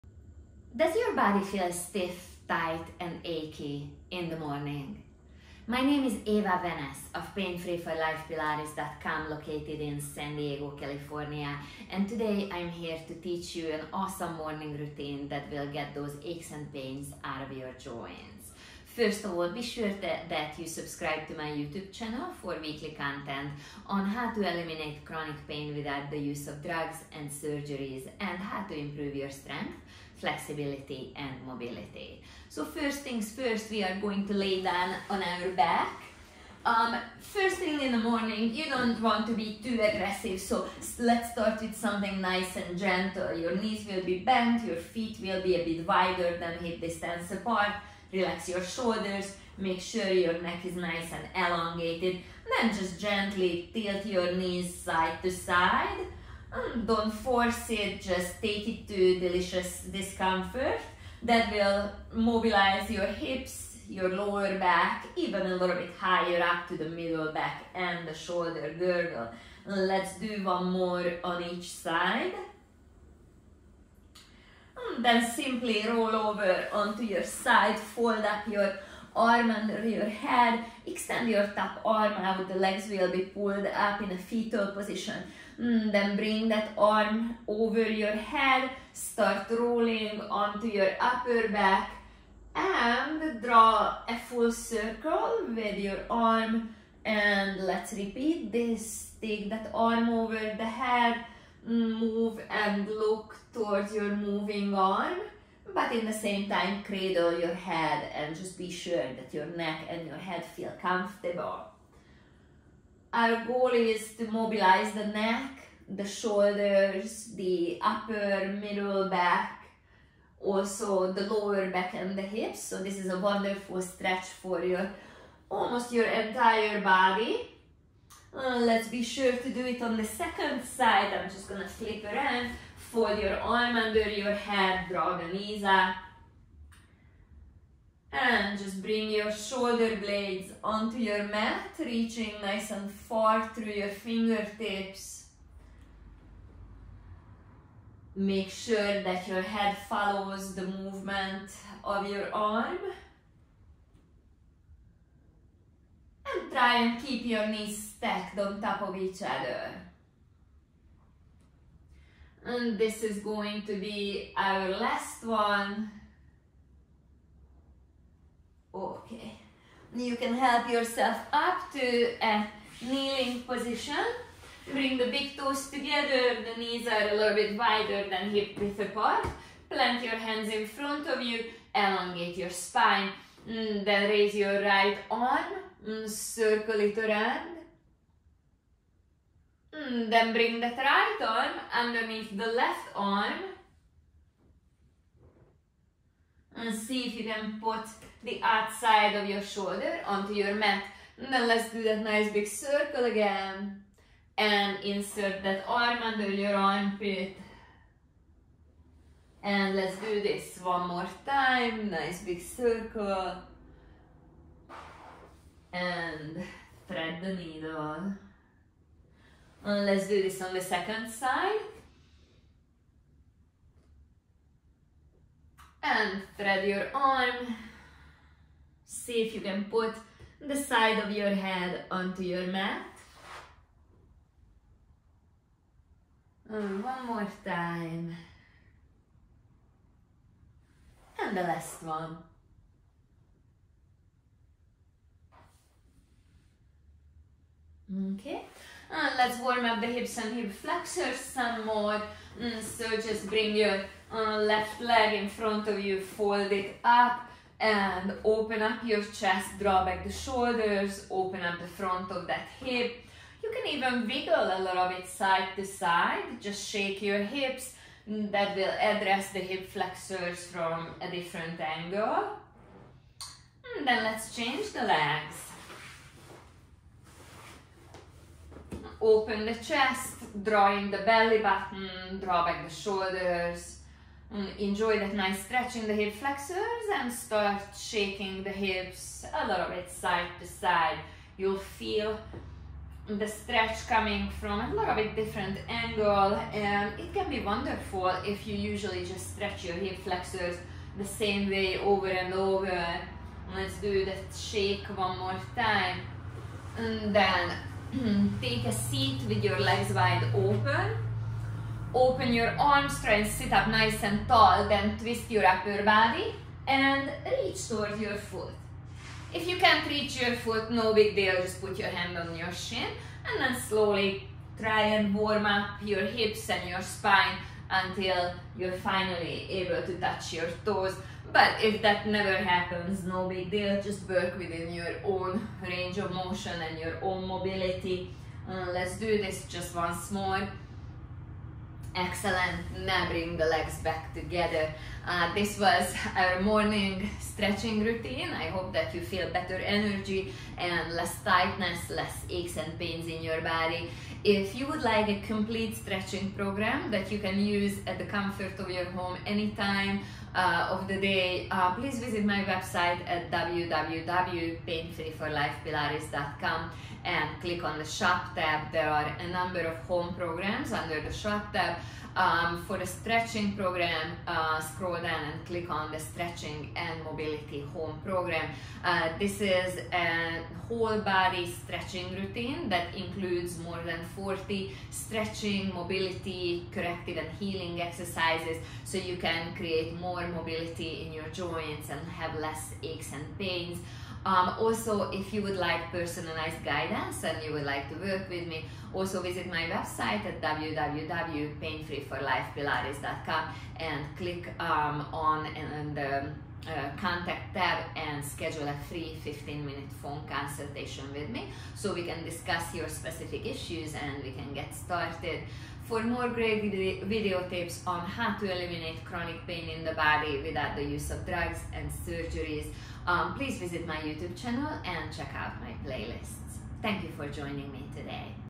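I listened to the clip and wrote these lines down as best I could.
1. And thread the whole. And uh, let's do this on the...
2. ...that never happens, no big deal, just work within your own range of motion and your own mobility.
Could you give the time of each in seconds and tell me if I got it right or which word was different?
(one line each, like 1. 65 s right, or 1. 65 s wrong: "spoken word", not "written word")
1. 215 s wrong: "needle", not "whole"
2. 331 s right.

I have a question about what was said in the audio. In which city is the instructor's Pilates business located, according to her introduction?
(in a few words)
San Diego.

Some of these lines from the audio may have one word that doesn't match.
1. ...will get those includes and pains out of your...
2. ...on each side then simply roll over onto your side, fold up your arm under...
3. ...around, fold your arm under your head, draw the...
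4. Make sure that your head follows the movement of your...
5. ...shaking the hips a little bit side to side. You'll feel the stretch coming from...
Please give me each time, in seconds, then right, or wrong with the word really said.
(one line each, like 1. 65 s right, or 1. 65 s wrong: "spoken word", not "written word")
1. 15 s wrong: "aches", not "includes"
2. 71 s right
3. 132 s right
4. 148 s right
5. 287 s right.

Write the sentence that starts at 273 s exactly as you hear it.
And mm, then let's change the legs.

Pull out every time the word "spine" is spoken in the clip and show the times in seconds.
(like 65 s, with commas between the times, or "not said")
182 s, 326 s.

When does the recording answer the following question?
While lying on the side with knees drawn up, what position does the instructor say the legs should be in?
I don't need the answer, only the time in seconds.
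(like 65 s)
84 s.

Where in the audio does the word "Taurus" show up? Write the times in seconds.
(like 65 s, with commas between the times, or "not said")
not said.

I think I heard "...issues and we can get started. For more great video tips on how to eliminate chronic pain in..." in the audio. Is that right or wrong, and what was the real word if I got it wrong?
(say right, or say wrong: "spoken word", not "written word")
right.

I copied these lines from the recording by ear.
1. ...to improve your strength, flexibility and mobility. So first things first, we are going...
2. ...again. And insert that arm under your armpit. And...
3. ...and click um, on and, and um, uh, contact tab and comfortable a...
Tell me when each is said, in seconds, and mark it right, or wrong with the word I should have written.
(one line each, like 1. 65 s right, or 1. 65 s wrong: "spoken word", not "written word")
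1. 28 s right
2. 203 s right
3. 403 s wrong: "schedule", not "comfortable".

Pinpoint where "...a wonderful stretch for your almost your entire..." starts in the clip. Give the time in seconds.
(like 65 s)
123 s.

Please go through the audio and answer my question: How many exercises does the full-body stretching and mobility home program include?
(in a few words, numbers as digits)
more than 40.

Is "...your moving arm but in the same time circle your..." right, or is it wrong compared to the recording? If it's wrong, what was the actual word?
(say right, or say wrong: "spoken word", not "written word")
wrong: "cradle", not "circle".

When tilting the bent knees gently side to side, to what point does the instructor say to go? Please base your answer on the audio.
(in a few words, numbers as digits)
delicious discomfort.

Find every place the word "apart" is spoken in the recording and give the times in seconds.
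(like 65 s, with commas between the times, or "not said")
47 s, 178 s.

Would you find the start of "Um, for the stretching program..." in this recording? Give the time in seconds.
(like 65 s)
372 s.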